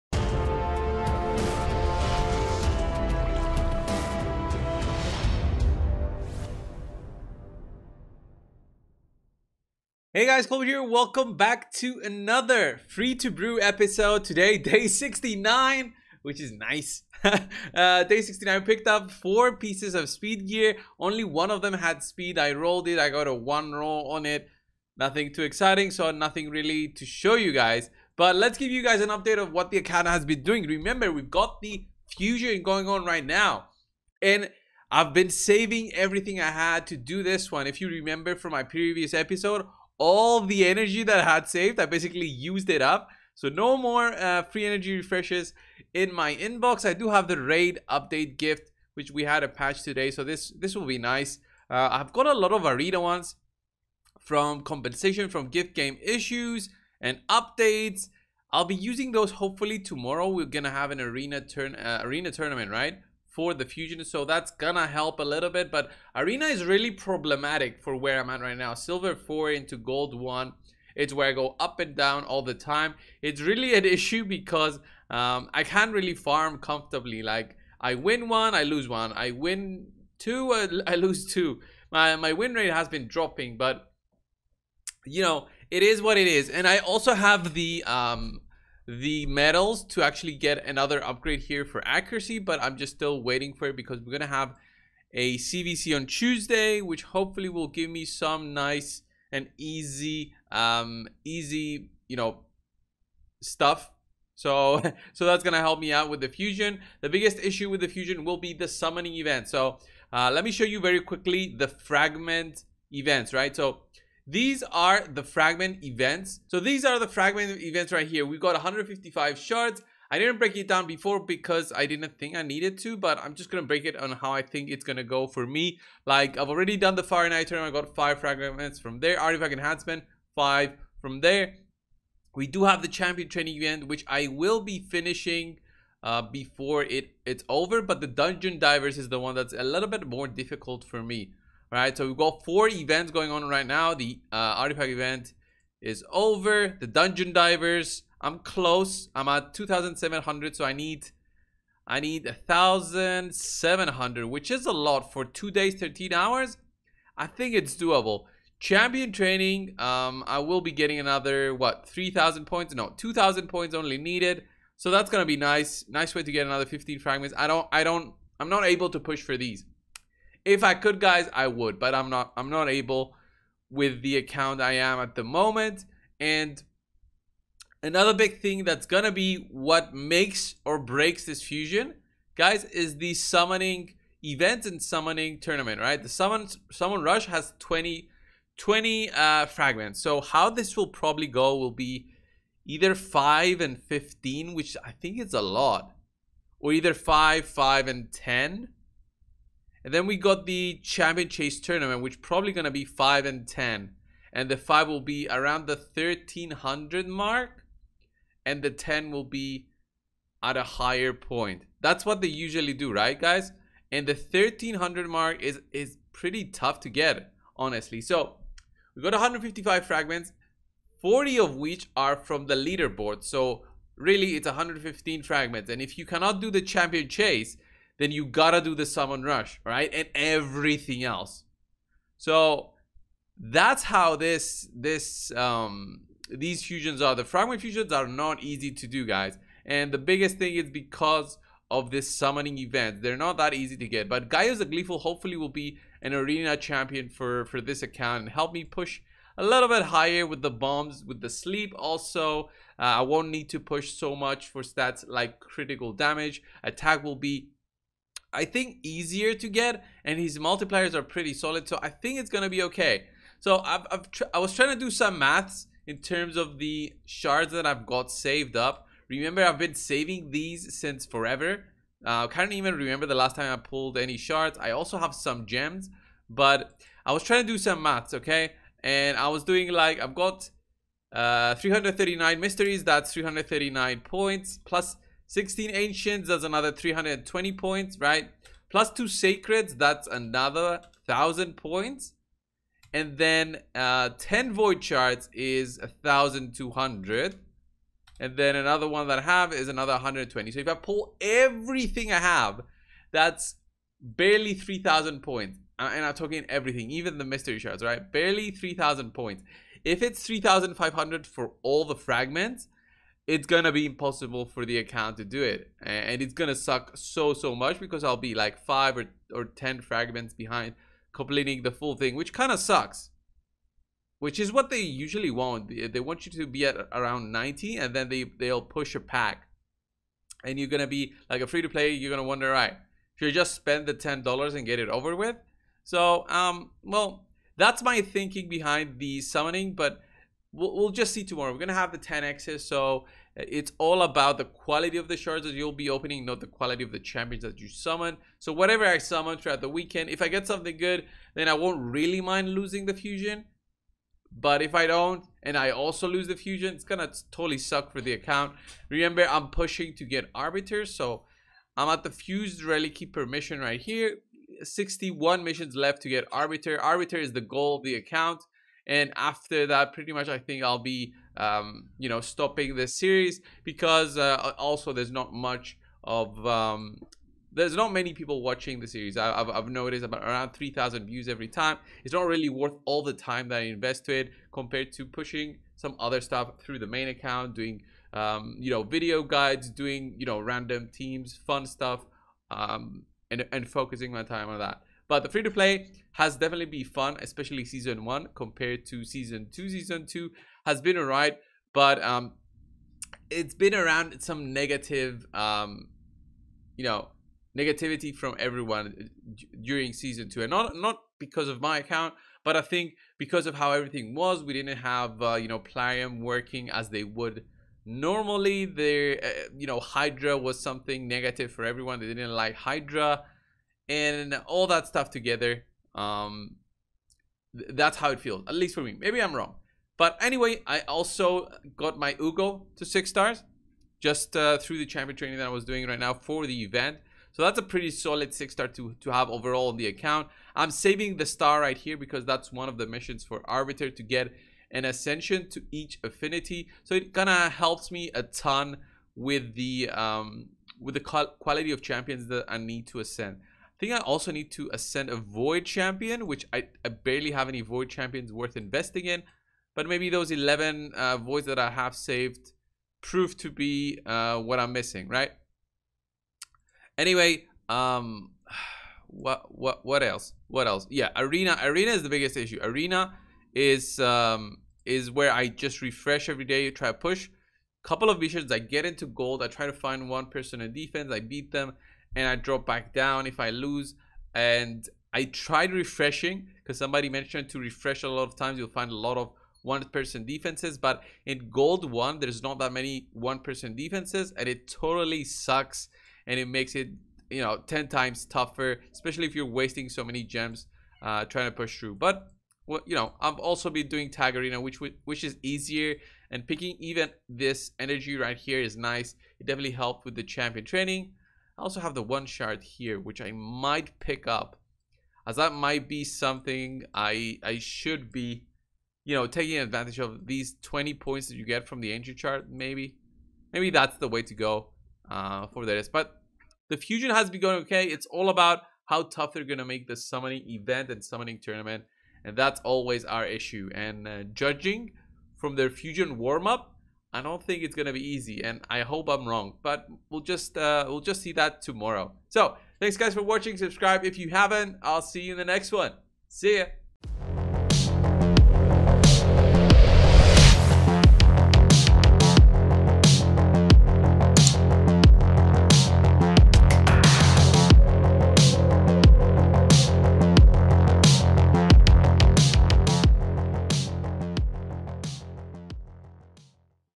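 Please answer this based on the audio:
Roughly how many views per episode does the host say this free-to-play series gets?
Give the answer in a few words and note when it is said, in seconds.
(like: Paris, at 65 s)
3000, at 380 s.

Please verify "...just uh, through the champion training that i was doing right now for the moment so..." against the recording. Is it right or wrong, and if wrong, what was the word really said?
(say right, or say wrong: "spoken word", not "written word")
wrong: "event", not "moment".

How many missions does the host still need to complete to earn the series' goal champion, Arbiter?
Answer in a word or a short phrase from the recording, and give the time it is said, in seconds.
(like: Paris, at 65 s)
61, at 364 s.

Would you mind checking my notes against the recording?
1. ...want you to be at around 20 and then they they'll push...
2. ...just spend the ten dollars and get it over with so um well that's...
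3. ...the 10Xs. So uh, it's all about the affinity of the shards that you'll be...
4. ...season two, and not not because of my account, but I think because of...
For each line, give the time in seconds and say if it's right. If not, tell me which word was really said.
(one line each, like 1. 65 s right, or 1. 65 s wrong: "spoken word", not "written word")
1. 325 s wrong: "90", not "20"
2. 333 s right
3. 341 s wrong: "quality", not "affinity"
4. 409 s right.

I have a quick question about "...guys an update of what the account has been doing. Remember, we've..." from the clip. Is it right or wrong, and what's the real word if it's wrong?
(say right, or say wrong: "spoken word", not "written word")
right.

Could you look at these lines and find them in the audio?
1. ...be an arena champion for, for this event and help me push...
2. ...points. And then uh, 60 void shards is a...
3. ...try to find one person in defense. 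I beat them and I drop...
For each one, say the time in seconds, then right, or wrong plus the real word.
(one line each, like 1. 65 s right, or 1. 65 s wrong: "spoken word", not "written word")
1. 245 s wrong: "account", not "event"
2. 291 s wrong: "10", not "60"
3. 479 s right.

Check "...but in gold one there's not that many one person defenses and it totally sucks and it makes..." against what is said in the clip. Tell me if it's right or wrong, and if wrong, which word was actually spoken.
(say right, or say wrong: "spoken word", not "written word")
right.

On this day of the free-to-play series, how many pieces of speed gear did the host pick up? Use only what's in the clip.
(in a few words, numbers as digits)
4.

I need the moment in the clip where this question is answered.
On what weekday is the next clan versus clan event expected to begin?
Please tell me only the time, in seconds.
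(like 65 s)
96 s.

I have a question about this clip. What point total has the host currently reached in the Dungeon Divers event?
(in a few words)
2700.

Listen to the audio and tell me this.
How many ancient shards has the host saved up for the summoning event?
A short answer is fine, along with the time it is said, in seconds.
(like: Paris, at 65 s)
16, at 285 s.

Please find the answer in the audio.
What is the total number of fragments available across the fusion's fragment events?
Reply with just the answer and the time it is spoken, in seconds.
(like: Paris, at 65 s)
155, at 118 s.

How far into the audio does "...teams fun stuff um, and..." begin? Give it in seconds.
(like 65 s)
390 s.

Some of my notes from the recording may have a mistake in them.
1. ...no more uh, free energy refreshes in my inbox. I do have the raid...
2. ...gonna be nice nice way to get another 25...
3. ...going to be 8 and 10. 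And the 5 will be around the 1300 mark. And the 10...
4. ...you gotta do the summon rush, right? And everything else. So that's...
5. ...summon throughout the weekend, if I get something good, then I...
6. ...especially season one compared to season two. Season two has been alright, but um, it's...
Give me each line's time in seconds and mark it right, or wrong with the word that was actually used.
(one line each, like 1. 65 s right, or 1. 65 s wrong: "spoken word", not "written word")
1. 43 s right
2. 165 s wrong: "15", not "25"
3. 202 s wrong: "5", not "8"
4. 228 s right
5. 348 s right
6. 397 s right.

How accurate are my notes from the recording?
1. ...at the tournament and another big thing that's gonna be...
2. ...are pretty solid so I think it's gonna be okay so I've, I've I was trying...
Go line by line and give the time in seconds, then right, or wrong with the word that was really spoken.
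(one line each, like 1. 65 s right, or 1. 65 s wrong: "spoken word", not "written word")
1. 174 s wrong: "moment", not "tournament"
2. 260 s right.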